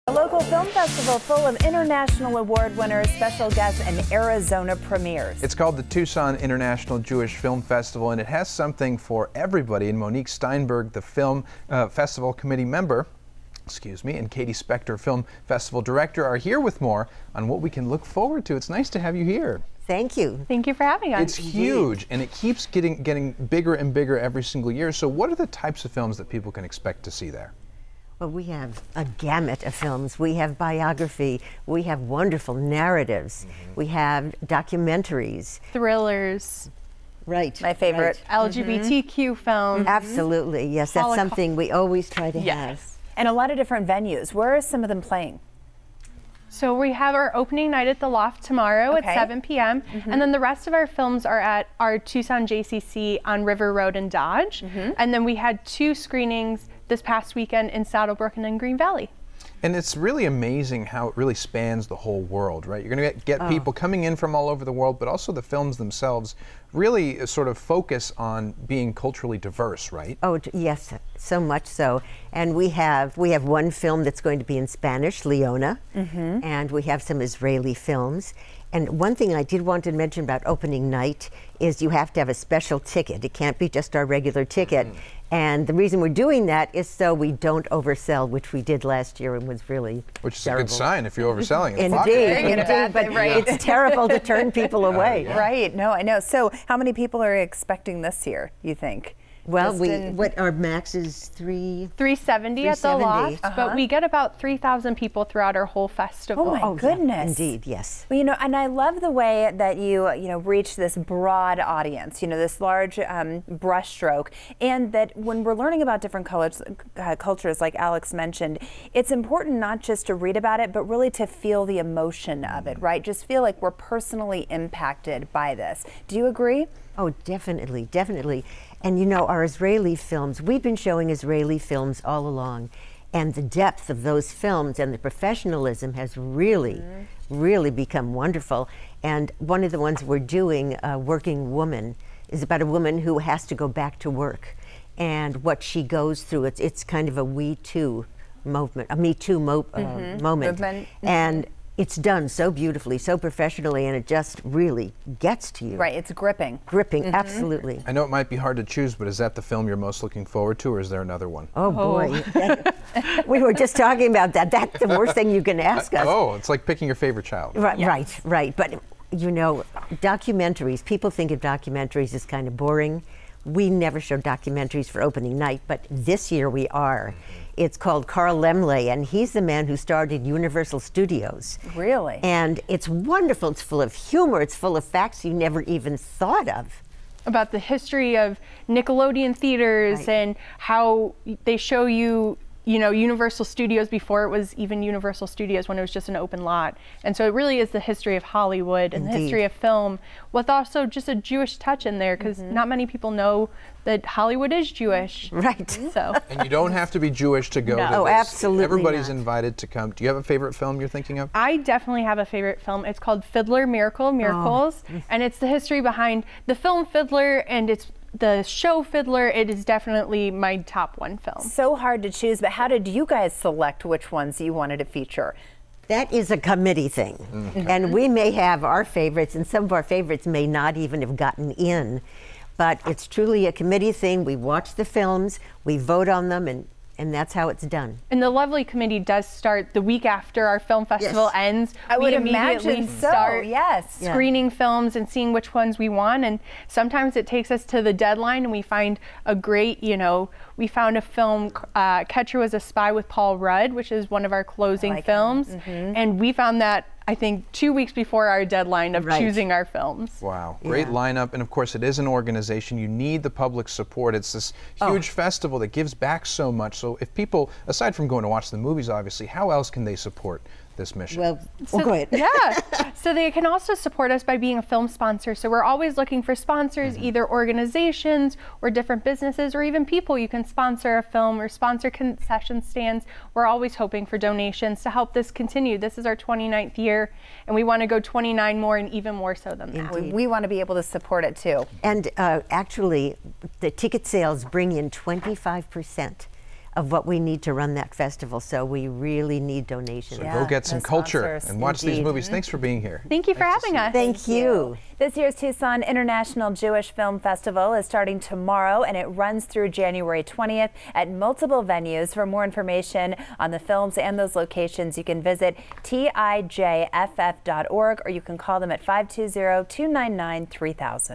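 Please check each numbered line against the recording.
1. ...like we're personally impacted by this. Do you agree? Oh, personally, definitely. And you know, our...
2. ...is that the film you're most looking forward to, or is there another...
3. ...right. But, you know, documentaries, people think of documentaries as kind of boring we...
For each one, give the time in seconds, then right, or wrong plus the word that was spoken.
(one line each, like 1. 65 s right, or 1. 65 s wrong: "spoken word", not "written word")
1. 123 s wrong: "definitely", not "personally"
2. 159 s right
3. 168 s right.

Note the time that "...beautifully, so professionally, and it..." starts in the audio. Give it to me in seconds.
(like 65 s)
152 s.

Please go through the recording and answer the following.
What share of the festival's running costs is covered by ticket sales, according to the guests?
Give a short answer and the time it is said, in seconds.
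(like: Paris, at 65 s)
25 percent, at 294 s.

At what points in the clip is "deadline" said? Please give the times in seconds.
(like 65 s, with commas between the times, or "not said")
247 s, 258 s.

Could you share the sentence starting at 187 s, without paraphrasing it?
About the history of Nickelodeon theaters right.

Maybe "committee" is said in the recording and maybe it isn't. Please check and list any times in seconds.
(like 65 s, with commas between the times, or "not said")
12 s, 226 s, 233 s, 238 s.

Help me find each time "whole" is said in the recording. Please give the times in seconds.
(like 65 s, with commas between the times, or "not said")
61 s, 105 s.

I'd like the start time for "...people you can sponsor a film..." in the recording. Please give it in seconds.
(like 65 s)
279 s.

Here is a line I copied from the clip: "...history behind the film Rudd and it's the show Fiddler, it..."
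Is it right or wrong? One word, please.
wrong.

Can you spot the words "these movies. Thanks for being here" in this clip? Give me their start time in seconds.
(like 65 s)
301 s.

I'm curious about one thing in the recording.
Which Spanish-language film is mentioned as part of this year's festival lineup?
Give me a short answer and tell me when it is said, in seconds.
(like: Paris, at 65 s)
Leona, at 75 s.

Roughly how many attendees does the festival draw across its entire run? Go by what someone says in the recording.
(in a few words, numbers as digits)
3000.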